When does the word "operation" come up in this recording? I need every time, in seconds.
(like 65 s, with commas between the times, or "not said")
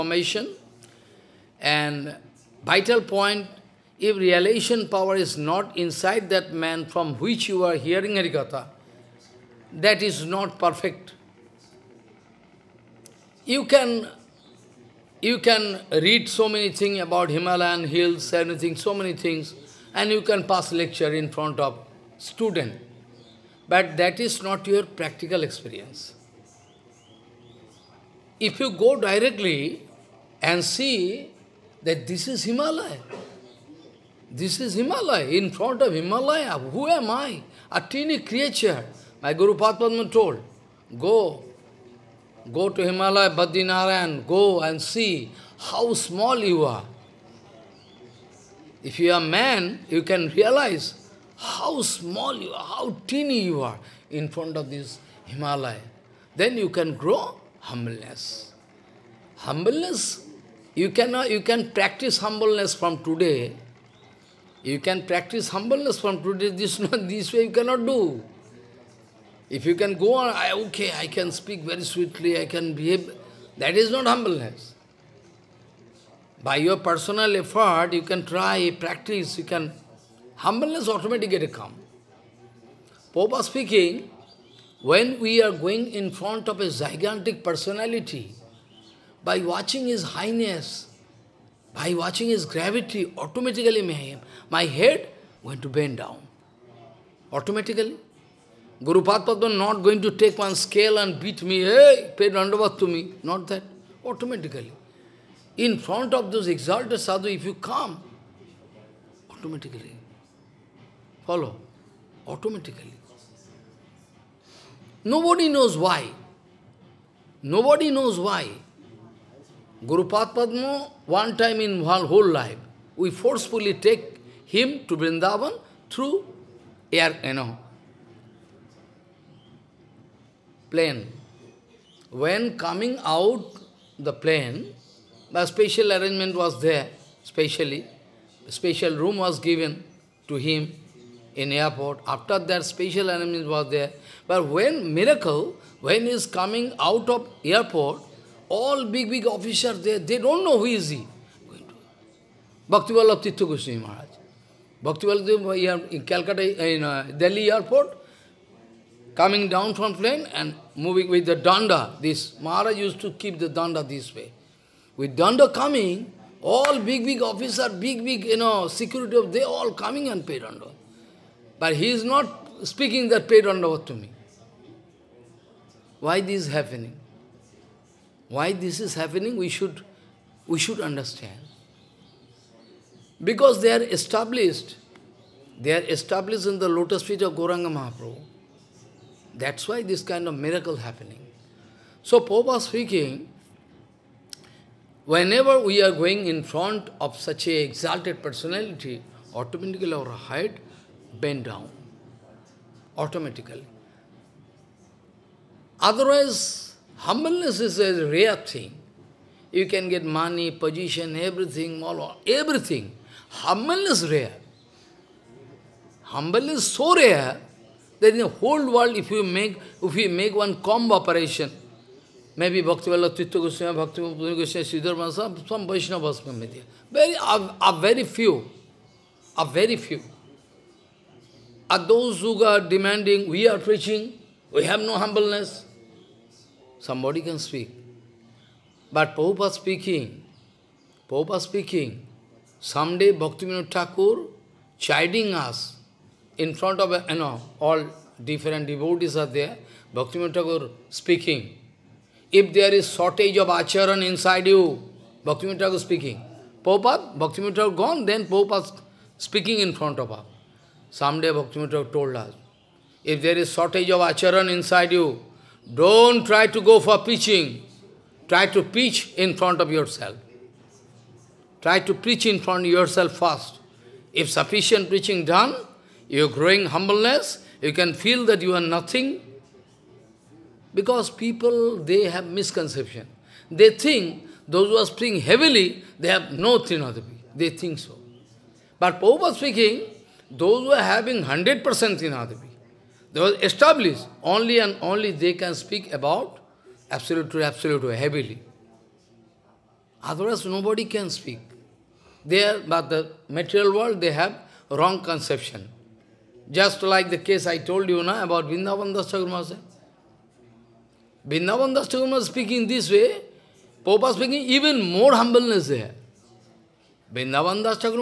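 220 s.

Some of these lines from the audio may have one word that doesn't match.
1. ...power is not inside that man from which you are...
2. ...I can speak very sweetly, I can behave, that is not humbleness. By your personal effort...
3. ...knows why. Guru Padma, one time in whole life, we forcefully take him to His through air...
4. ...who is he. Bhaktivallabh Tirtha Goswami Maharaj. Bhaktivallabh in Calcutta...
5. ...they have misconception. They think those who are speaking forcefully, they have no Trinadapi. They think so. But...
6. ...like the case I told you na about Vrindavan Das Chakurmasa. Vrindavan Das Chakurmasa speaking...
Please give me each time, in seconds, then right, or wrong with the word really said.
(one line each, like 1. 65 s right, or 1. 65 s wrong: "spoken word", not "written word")
1. 4 s right
2. 70 s right
3. 117 s wrong: "Vrindavan", not "His"
4. 150 s right
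5. 281 s wrong: "heavily", not "forcefully"
6. 306 s right.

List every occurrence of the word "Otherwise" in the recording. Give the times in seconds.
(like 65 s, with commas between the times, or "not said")
205 s, 300 s.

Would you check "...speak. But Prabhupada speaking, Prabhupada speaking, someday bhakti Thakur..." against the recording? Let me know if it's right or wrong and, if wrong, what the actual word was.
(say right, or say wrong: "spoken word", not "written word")
right.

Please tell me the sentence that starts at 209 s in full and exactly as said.
You can get money, position, everything, all, everything.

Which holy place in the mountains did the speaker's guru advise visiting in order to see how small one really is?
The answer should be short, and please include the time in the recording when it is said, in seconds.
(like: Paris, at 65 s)
Badrinarayan, at 43 s.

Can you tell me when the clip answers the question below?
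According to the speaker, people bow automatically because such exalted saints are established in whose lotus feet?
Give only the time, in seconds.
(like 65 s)
187 s.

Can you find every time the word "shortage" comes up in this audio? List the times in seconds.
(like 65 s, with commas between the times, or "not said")
252 s, 263 s.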